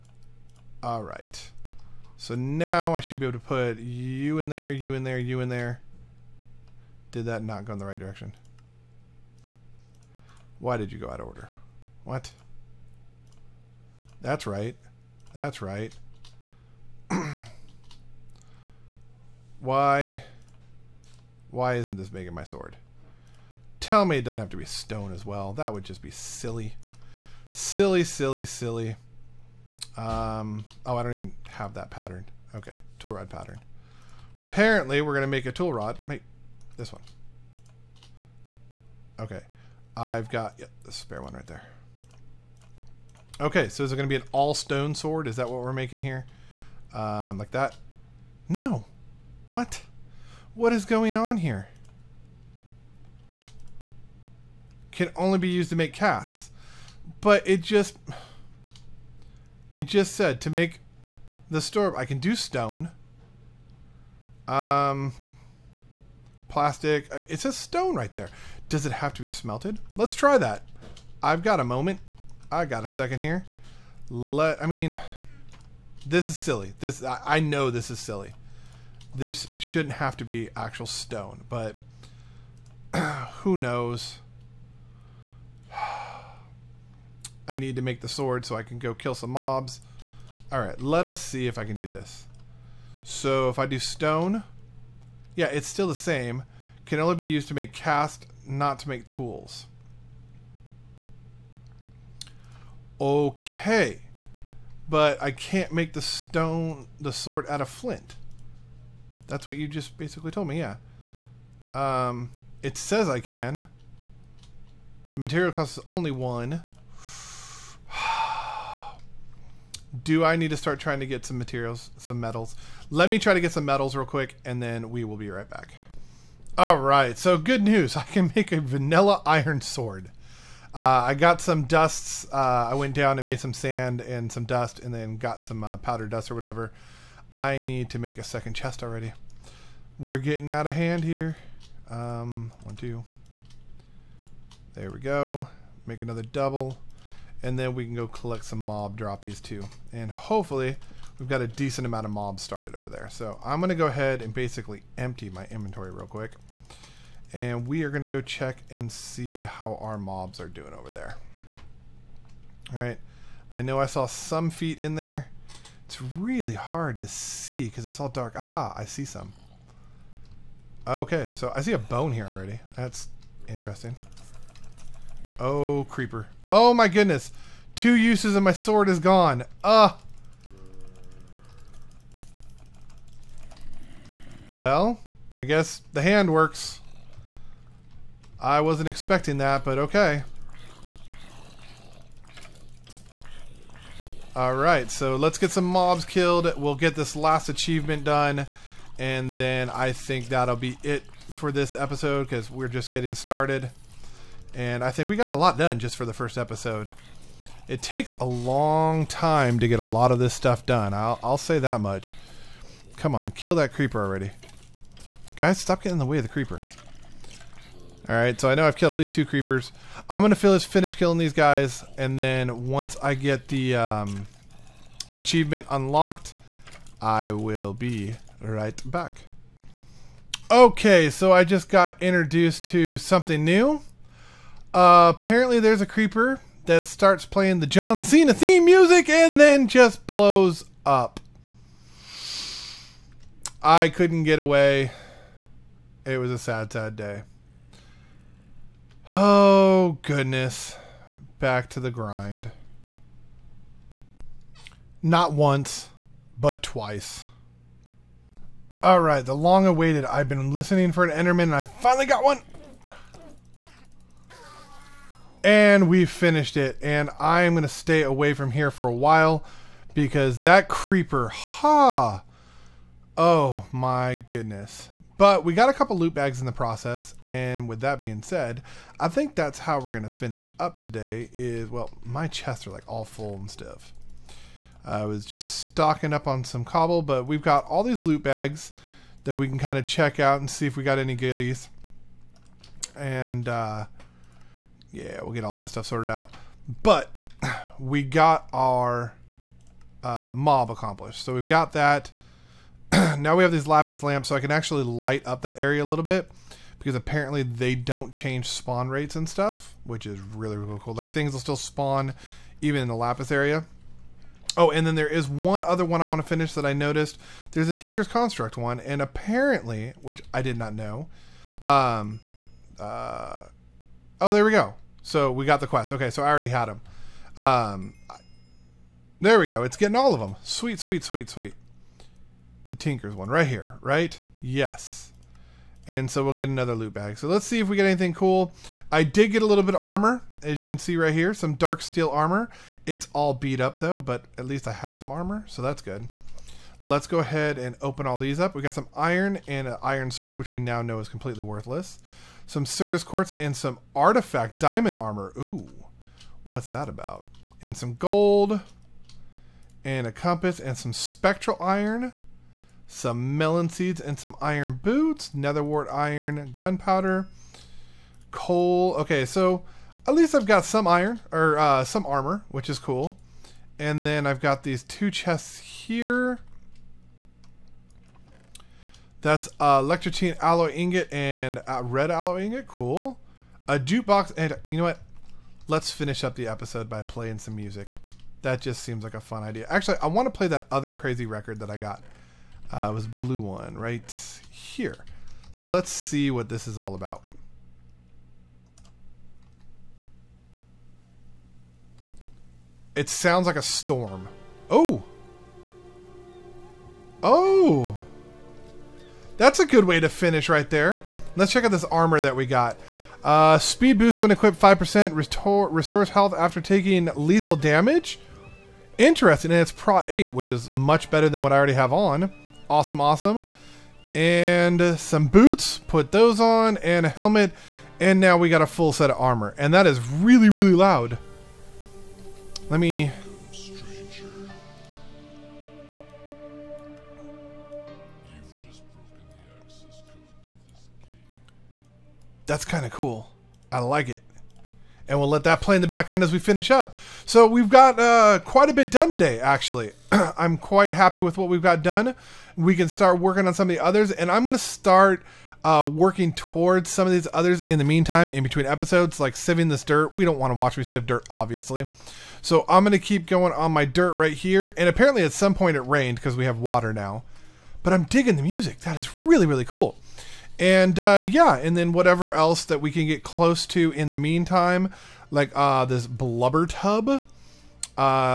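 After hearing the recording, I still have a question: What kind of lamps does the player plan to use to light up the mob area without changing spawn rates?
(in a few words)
Lapis lamps.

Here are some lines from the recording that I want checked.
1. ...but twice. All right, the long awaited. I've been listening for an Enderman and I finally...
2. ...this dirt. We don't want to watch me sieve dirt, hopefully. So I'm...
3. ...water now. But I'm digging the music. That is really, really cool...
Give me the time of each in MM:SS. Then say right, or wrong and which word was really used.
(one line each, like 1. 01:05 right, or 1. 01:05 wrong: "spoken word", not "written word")
1. 04:16 right
2. 07:39 wrong: "obviously", not "hopefully"
3. 07:46 right.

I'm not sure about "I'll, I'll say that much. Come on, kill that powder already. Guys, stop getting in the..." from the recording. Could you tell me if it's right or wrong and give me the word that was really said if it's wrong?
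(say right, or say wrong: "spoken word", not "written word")
wrong: "creeper", not "powder".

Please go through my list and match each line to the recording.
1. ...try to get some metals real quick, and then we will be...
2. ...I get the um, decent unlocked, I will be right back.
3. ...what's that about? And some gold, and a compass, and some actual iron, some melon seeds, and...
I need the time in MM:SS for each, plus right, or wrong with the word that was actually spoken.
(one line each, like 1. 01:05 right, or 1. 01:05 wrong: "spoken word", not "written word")
1. 02:03 right
2. 03:43 wrong: "achievement", not "decent"
3. 05:56 wrong: "spectral", not "actual".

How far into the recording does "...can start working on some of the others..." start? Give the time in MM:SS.
07:32.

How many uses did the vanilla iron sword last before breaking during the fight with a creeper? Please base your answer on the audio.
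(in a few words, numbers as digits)
2.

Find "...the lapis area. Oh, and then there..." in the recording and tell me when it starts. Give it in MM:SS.
05:12.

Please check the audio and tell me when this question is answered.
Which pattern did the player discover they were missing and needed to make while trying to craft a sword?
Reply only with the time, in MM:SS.
00:32.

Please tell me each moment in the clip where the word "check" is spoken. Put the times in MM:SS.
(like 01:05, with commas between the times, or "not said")
02:38, 04:49, 06:51.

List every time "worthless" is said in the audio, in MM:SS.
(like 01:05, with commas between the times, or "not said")
05:51.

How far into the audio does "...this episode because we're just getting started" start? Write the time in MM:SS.
03:21.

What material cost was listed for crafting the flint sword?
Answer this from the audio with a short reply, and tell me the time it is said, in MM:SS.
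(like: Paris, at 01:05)
1, at 01:55.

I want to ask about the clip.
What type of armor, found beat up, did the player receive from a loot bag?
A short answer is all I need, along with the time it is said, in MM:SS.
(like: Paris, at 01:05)
Dark steel armor, at 05:41.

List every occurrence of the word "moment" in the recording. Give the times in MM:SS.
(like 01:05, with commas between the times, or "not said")
01:11.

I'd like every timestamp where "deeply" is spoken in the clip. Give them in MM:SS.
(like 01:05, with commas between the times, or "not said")
not said.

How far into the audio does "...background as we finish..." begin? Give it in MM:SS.
07:25.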